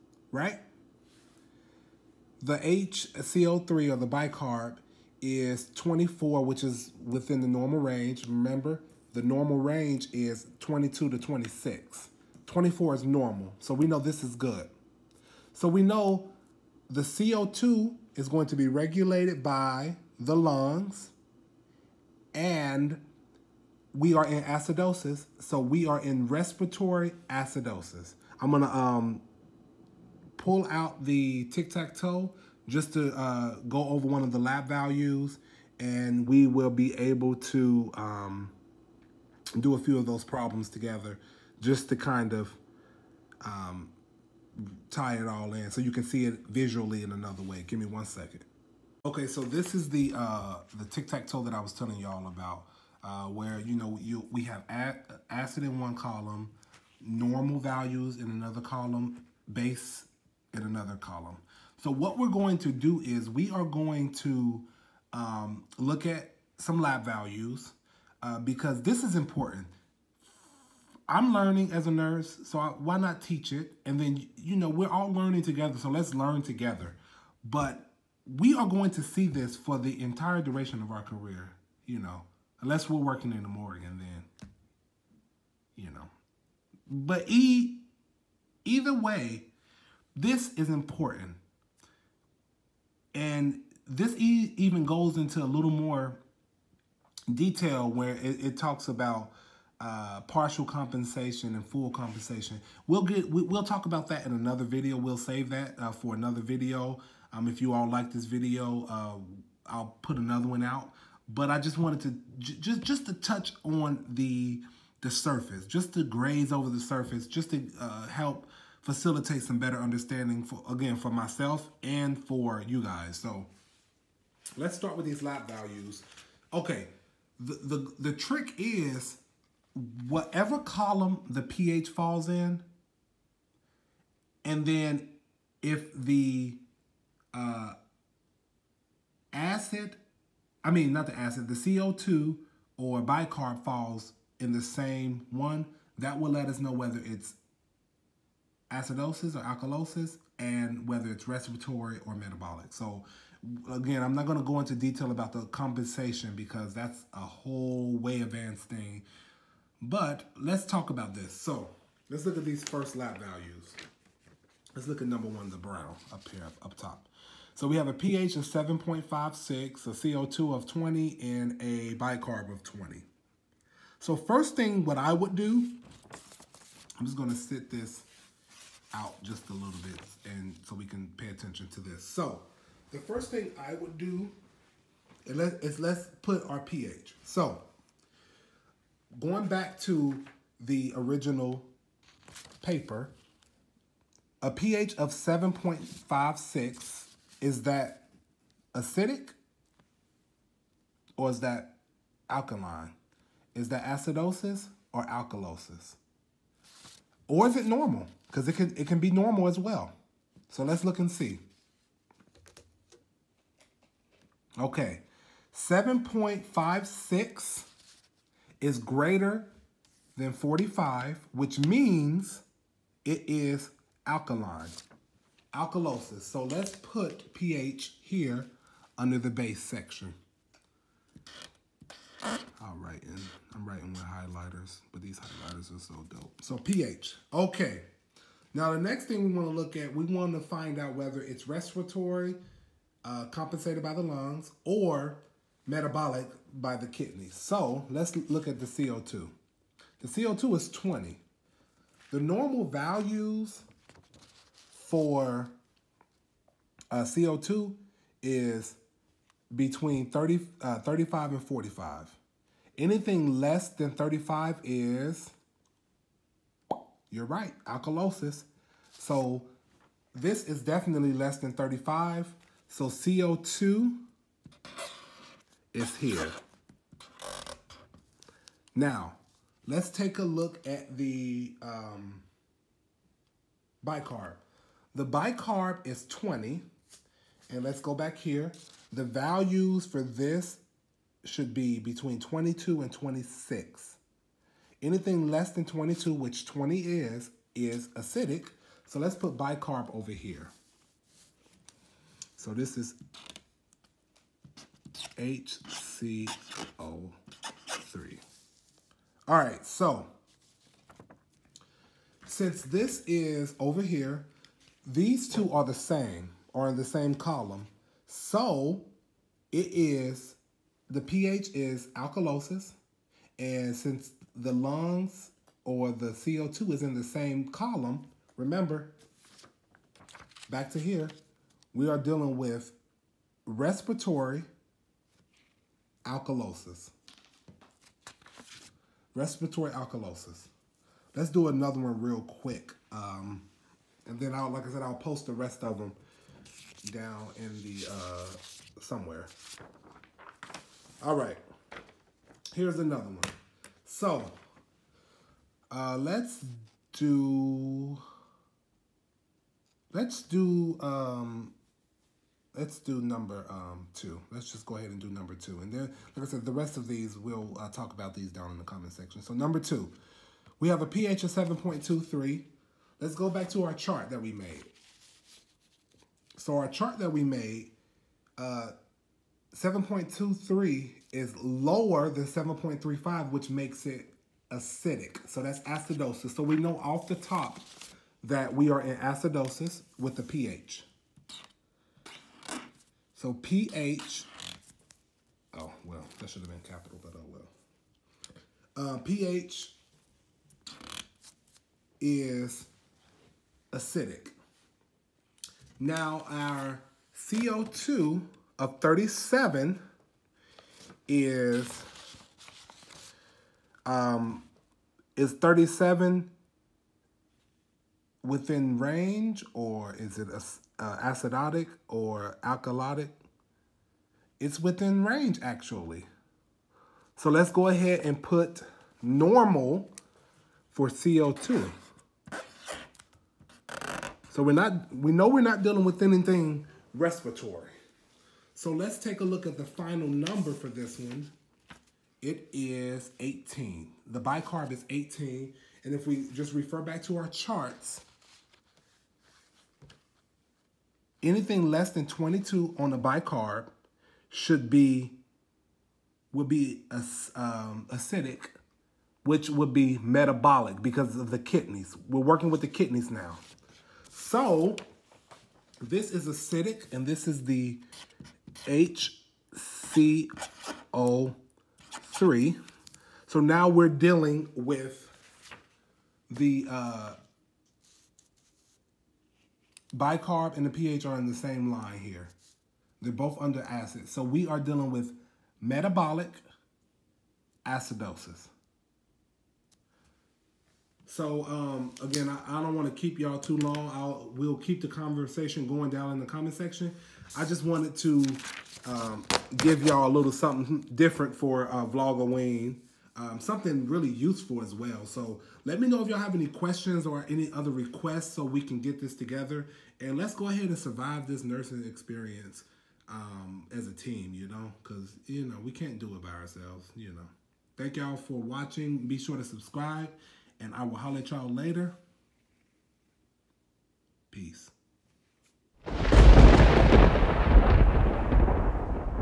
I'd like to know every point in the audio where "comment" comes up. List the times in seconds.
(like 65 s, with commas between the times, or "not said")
368 s, 496 s.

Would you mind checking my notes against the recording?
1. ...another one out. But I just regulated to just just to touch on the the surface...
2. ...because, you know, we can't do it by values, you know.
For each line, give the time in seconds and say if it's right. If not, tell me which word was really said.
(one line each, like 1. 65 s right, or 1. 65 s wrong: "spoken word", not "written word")
1. 110 s wrong: "wanted", not "regulated"
2. 514 s wrong: "ourselves", not "values".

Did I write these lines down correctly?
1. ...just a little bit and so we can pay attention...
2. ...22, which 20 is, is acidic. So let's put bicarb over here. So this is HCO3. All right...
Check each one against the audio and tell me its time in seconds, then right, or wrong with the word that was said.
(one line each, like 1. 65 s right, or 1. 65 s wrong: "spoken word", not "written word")
1. 179 s right
2. 295 s right.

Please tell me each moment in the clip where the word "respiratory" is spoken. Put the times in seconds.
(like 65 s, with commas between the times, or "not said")
26 s, 151 s, 241 s, 333 s, 339 s, 436 s.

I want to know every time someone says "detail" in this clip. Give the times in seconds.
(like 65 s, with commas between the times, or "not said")
97 s, 154 s.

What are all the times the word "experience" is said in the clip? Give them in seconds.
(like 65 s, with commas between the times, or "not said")
511 s.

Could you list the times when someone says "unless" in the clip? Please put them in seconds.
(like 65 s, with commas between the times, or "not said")
82 s.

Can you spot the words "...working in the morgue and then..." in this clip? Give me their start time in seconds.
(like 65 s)
82 s.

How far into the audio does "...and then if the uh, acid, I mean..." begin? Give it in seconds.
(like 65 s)
134 s.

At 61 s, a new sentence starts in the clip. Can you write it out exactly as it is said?
So what we're going to do is we are going to um, look at some lab values uh, because this is important.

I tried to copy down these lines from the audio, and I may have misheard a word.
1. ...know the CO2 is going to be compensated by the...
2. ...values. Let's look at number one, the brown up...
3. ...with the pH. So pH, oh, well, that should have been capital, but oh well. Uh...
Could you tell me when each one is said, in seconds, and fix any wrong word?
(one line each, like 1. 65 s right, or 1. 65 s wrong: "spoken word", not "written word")
1. 15 s wrong: "regulated", not "compensated"
2. 163 s right
3. 389 s right.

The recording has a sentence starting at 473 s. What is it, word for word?
So now we're dealing with the uh, bicarb and the pH are in the same line here.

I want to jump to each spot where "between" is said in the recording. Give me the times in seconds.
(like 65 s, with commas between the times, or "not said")
259 s, 291 s.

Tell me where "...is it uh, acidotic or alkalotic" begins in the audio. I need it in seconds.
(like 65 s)
419 s.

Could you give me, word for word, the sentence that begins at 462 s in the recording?
We're working with the kidneys now.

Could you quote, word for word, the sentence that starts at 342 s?
Um, and then I'll, like I said, I'll post the rest of them down in the, uh, somewhere.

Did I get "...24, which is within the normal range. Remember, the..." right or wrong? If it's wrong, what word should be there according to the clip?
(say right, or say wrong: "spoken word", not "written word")
right.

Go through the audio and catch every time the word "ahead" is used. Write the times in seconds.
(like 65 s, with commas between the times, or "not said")
364 s, 427 s, 510 s.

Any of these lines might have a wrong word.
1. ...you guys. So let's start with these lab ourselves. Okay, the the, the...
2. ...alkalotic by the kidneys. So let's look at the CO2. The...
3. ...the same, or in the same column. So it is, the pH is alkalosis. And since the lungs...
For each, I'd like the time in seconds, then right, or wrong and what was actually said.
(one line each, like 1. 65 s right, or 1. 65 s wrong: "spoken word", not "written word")
1. 122 s wrong: "values", not "ourselves"
2. 245 s wrong: "metabolic", not "alkalotic"
3. 315 s right.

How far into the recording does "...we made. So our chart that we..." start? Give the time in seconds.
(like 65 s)
374 s.